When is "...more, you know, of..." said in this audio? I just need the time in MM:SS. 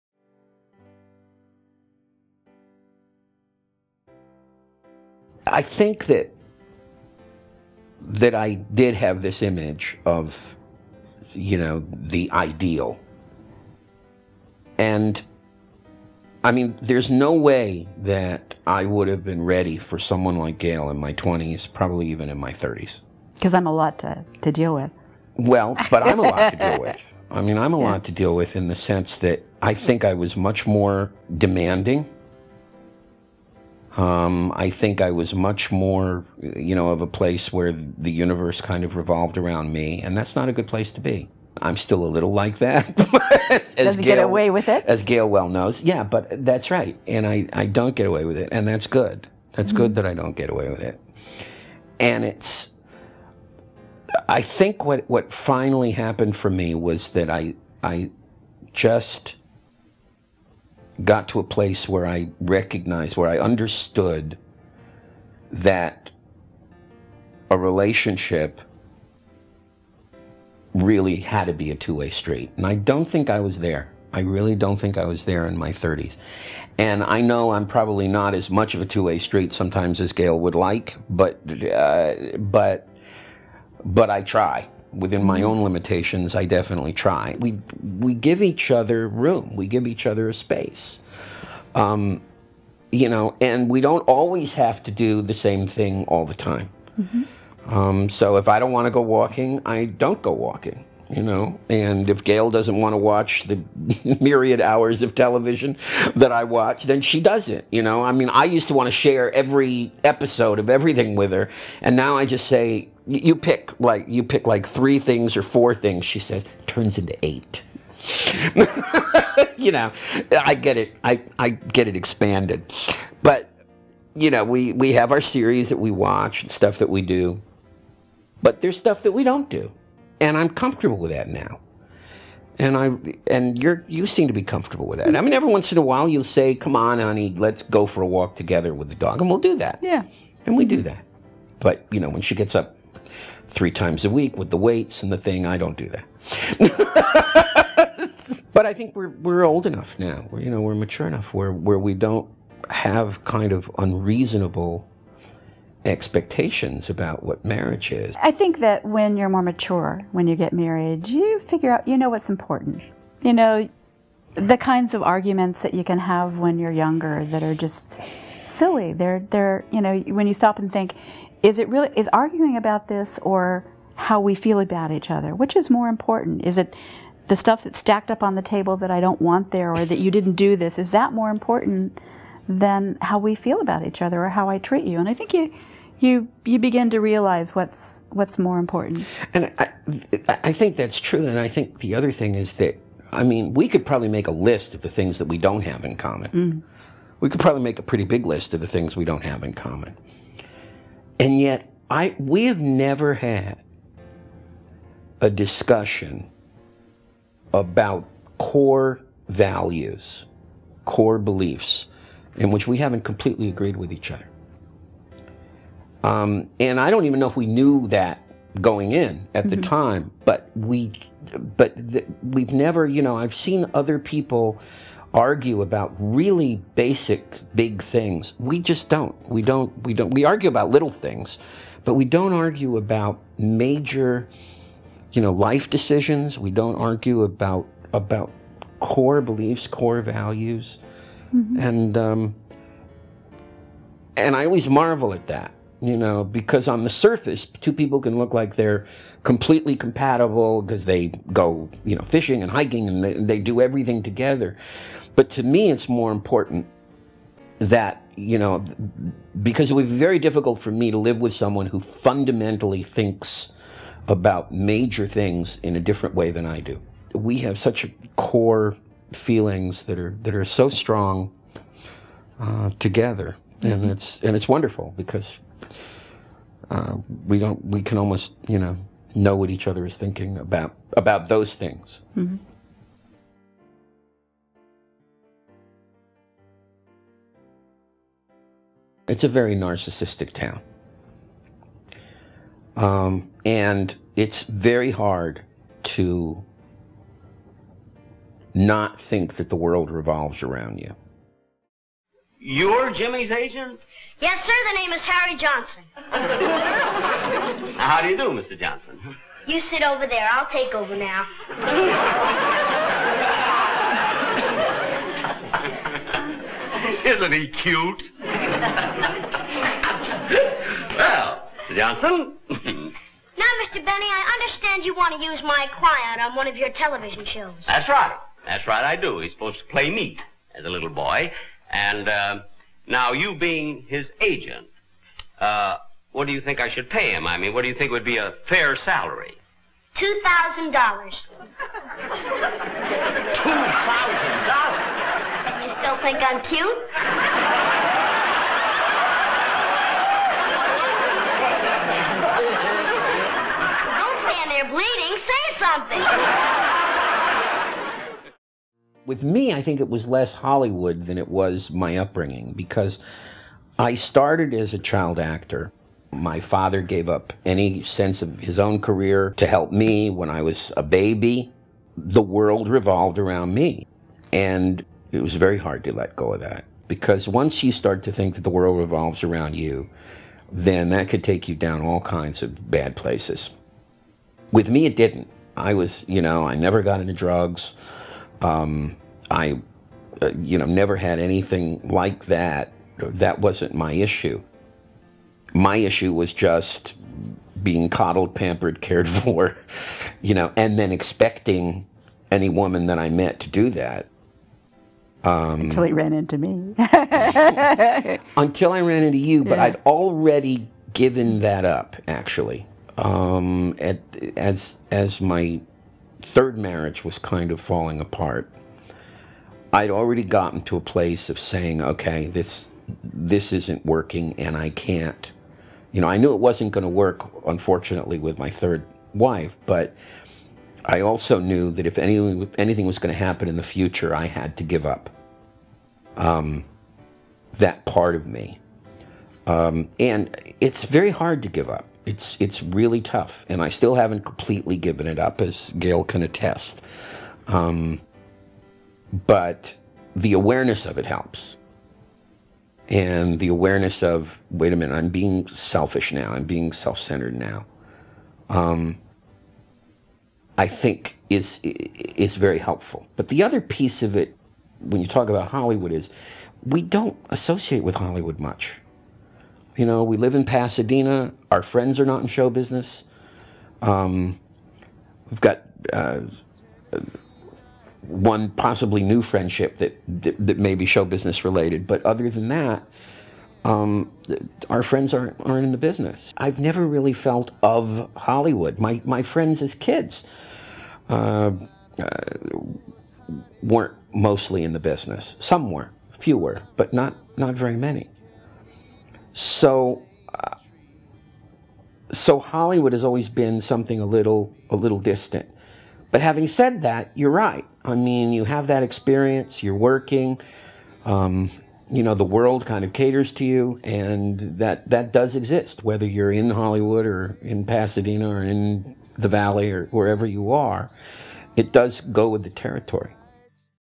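00:35.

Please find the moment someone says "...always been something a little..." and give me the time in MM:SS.
08:23.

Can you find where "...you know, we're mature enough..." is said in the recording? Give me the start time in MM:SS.
02:30.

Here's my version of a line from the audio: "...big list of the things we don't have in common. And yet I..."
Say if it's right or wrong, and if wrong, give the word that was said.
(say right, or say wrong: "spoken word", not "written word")
right.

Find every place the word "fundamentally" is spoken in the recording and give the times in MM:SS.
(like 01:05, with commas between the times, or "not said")
04:21.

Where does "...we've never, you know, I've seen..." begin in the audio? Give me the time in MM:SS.
03:42.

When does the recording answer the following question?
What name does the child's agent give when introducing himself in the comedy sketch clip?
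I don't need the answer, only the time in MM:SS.
05:05.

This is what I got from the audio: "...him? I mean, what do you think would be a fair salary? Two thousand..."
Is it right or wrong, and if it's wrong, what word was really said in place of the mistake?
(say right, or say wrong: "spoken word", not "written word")
right.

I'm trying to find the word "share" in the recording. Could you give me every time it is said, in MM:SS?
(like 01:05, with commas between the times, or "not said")
01:48.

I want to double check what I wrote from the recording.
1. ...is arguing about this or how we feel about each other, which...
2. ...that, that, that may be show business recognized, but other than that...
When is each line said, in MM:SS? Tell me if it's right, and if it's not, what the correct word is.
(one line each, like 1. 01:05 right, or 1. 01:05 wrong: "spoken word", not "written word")
1. 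02:51 right
2. 07:59 wrong: "related", not "recognized".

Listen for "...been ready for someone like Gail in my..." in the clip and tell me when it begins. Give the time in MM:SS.
00:19.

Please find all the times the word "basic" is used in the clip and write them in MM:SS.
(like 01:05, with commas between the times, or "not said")
03:46.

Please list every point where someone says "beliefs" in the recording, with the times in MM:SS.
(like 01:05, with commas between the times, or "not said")
03:31, 03:59.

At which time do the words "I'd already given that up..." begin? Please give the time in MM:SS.
06:49.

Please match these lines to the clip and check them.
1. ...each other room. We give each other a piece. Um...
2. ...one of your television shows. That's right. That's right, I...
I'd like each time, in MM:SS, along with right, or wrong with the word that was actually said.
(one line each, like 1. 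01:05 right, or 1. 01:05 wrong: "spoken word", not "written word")
1. 01:28 wrong: "space", not "piece"
2. 05:26 right.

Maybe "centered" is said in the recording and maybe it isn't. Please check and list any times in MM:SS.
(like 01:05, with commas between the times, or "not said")
07:36.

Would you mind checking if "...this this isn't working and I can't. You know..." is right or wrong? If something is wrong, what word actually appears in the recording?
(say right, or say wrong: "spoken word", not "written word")
right.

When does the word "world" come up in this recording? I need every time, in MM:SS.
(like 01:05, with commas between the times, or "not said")
04:59, 06:12, 06:18, 08:32.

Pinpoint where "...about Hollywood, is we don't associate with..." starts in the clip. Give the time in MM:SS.
07:45.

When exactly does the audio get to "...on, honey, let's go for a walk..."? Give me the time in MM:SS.
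02:16.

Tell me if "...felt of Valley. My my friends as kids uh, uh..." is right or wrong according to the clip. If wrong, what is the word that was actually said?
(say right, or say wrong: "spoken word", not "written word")
wrong: "Hollywood", not "Valley".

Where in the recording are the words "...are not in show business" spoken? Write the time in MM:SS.
07:51.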